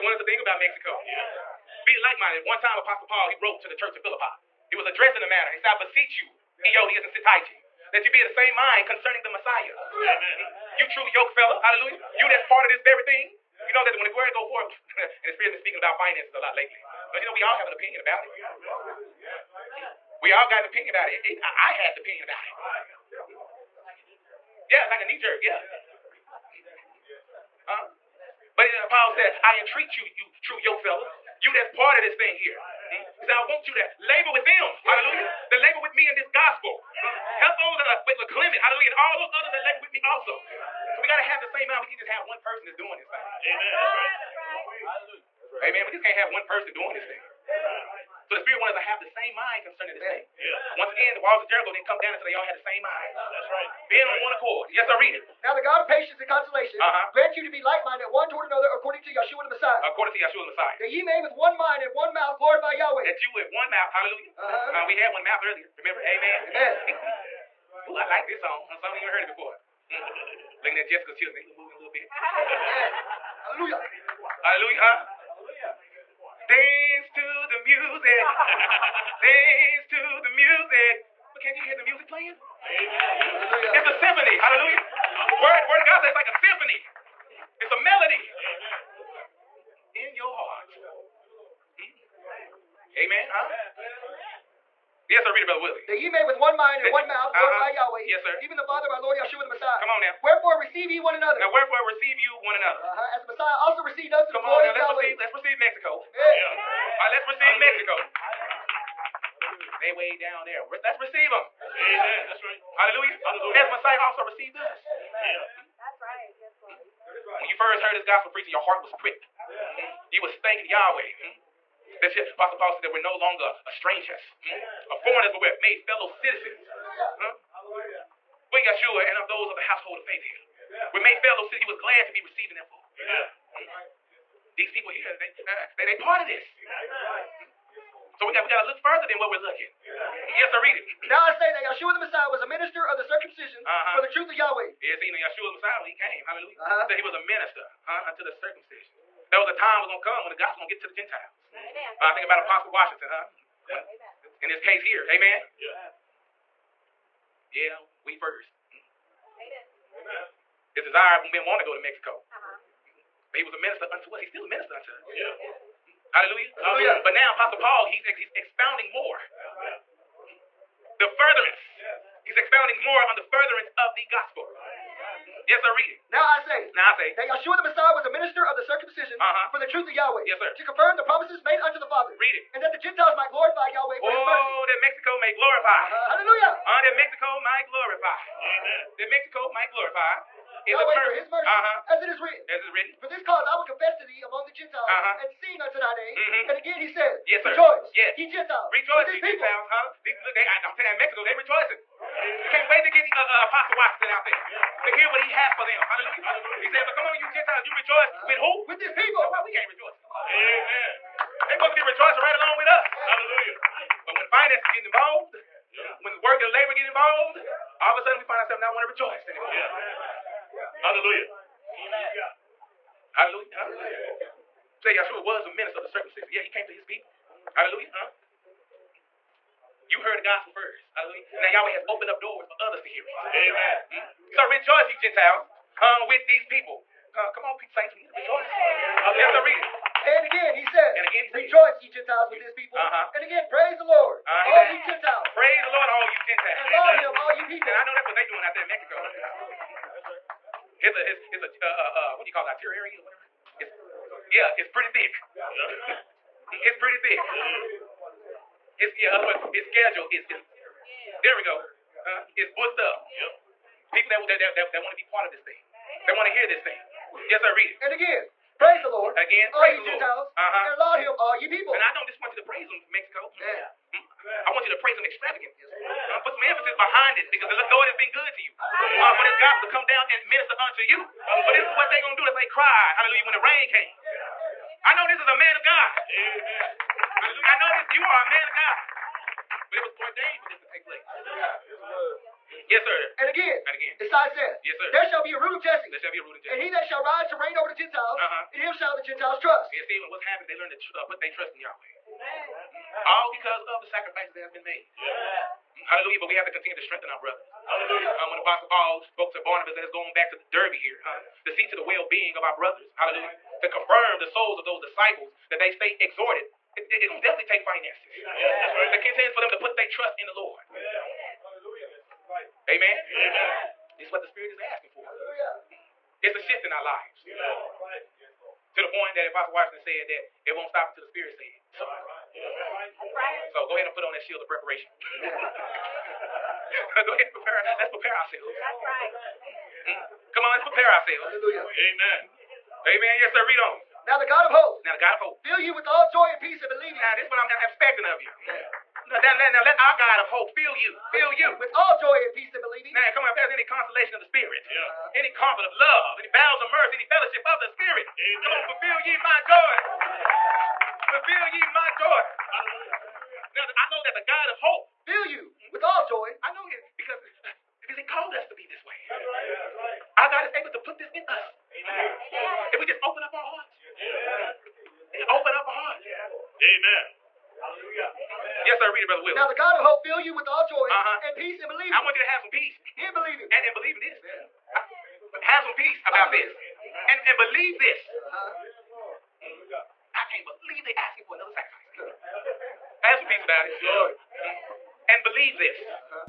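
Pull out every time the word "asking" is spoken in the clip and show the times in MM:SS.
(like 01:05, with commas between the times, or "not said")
05:24, 06:30.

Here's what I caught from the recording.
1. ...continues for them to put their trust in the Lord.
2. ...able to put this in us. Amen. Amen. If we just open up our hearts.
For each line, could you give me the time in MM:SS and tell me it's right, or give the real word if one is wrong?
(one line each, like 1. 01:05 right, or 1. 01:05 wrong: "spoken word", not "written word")
1. 05:19 right
2. 06:10 right.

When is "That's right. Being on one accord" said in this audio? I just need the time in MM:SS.
00:53.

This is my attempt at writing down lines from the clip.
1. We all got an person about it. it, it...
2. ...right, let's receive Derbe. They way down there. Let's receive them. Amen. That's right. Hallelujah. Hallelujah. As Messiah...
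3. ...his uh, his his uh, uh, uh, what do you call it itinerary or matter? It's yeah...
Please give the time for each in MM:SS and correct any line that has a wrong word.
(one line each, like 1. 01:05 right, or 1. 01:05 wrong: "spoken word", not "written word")
1. 00:20 wrong: "opinion", not "person"
2. 01:47 wrong: "Mexico", not "Derbe"
3. 04:10 wrong: "whatever", not "matter".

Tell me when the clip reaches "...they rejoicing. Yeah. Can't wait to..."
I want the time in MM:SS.
03:21.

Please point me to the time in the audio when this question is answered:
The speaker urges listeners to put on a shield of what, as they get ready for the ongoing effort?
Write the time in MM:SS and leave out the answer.
05:34.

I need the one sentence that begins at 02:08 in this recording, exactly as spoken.
We Yeshua and of those of the household of faith here.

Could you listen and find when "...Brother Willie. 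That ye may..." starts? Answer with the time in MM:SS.
01:35.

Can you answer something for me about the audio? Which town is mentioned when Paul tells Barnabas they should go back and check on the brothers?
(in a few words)
Derbe.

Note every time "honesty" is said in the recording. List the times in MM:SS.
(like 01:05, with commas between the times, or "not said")
not said.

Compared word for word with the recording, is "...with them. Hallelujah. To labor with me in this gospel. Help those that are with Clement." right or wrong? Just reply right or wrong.
right.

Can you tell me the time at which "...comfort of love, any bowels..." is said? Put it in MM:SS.
05:55.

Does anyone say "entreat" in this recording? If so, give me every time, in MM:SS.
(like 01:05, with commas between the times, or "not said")
00:29.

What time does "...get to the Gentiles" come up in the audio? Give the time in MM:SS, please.
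02:30.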